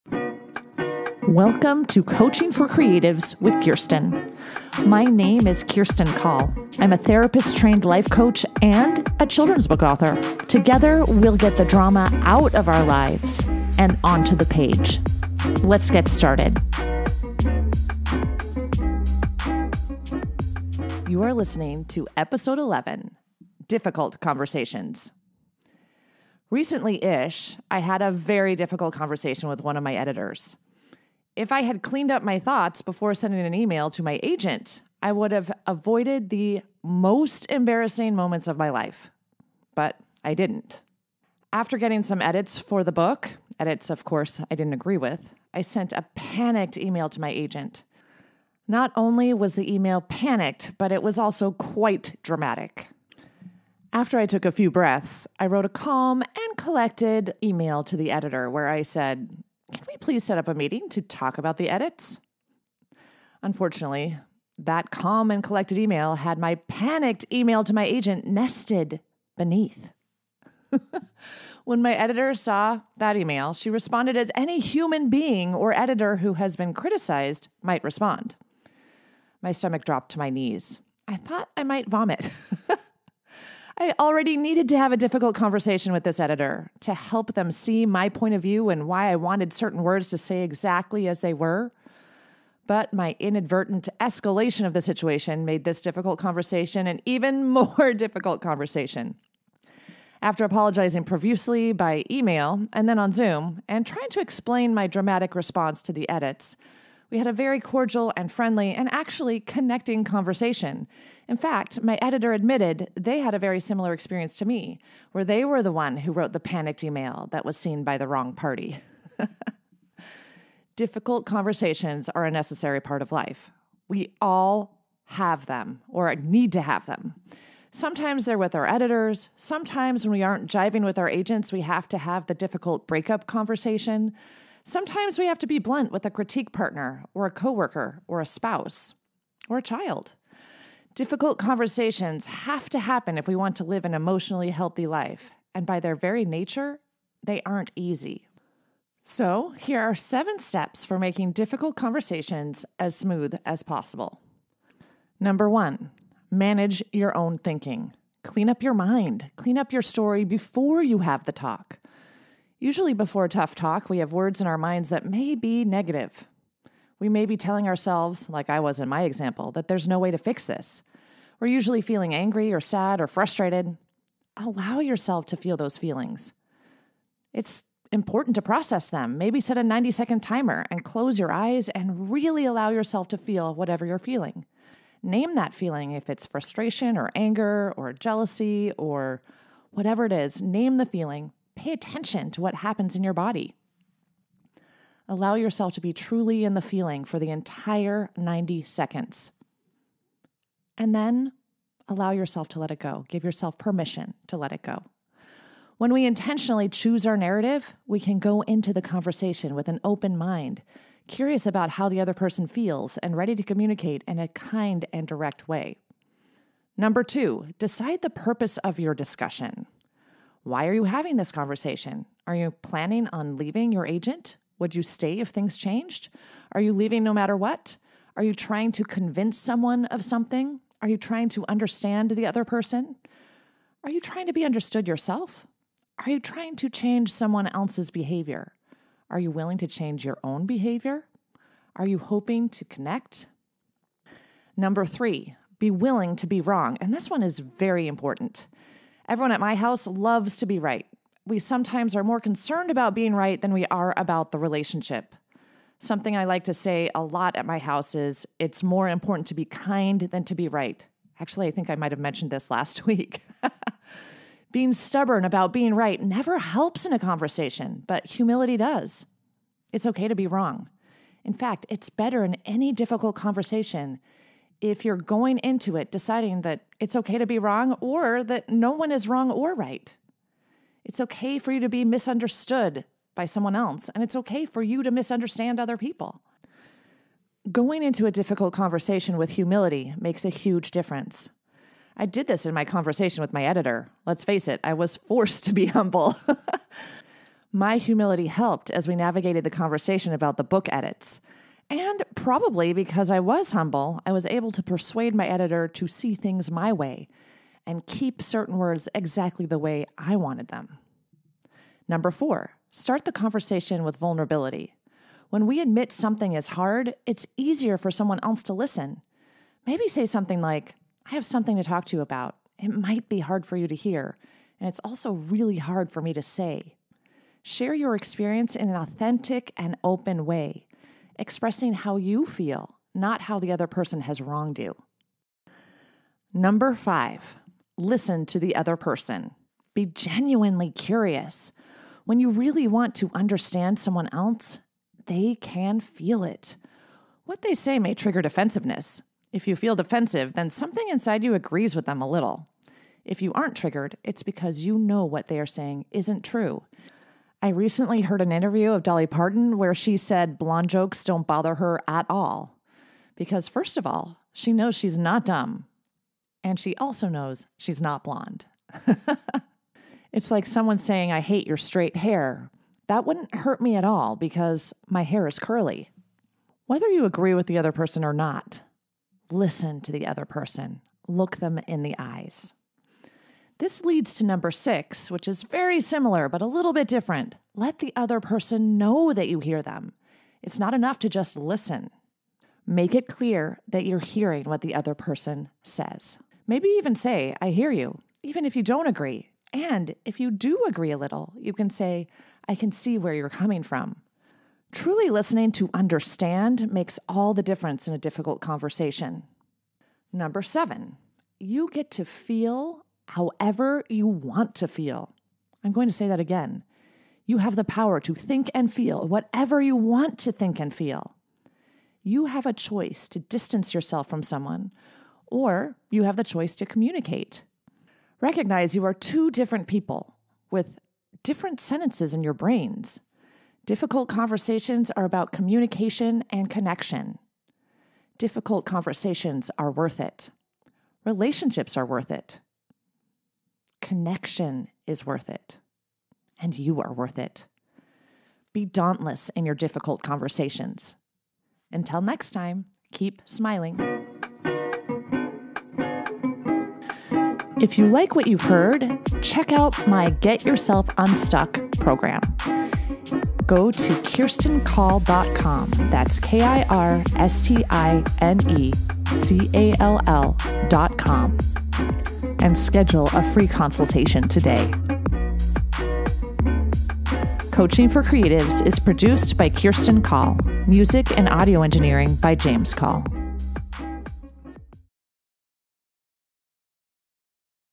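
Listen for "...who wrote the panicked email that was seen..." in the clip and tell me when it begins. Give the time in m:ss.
1:55.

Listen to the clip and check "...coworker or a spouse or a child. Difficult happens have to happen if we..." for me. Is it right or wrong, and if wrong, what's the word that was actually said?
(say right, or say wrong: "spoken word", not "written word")
wrong: "conversations", not "happens".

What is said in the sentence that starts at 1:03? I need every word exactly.
Unfortunately, that calm and collected email had my panicked email to my agent nested beneath.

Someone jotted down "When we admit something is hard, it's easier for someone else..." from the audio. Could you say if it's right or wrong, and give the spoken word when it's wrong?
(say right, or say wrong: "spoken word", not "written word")
right.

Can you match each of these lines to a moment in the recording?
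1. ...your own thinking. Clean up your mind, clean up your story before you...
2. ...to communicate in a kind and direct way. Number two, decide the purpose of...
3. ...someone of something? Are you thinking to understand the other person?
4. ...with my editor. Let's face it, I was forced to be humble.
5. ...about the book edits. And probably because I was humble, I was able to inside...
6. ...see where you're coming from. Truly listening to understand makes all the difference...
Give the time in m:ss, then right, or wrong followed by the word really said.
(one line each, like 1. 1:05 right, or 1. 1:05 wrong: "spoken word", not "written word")
1. 2:36 right
2. 3:33 right
3. 3:49 wrong: "trying", not "thinking"
4. 4:53 right
5. 5:00 wrong: "persuade", not "inside"
6. 6:42 right.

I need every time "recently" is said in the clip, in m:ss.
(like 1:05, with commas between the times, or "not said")
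0:26, 5:57.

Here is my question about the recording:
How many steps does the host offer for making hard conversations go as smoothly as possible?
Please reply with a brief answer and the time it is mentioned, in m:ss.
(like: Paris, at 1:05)
7, at 2:29.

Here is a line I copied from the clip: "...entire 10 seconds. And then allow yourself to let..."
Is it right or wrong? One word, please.
wrong.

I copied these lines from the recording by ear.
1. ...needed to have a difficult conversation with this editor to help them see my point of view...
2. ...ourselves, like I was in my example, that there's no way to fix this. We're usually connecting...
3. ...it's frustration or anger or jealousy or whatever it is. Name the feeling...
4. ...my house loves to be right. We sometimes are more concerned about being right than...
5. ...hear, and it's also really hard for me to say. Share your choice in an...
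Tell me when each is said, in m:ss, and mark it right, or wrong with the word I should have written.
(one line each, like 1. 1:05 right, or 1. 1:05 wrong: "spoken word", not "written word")
1. 1:24 right
2. 2:47 wrong: "feeling", not "connecting"
3. 3:06 right
4. 4:09 right
5. 5:23 wrong: "experience", not "choice".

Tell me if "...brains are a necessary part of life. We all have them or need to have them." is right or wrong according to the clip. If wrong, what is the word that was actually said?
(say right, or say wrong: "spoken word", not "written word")
wrong: "conversations", not "brains".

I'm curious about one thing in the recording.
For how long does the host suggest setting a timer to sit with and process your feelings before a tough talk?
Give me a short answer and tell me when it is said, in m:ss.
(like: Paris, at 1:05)
90 seconds, at 2:59.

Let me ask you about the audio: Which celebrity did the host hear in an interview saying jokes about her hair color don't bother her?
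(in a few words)
Dolly Parton.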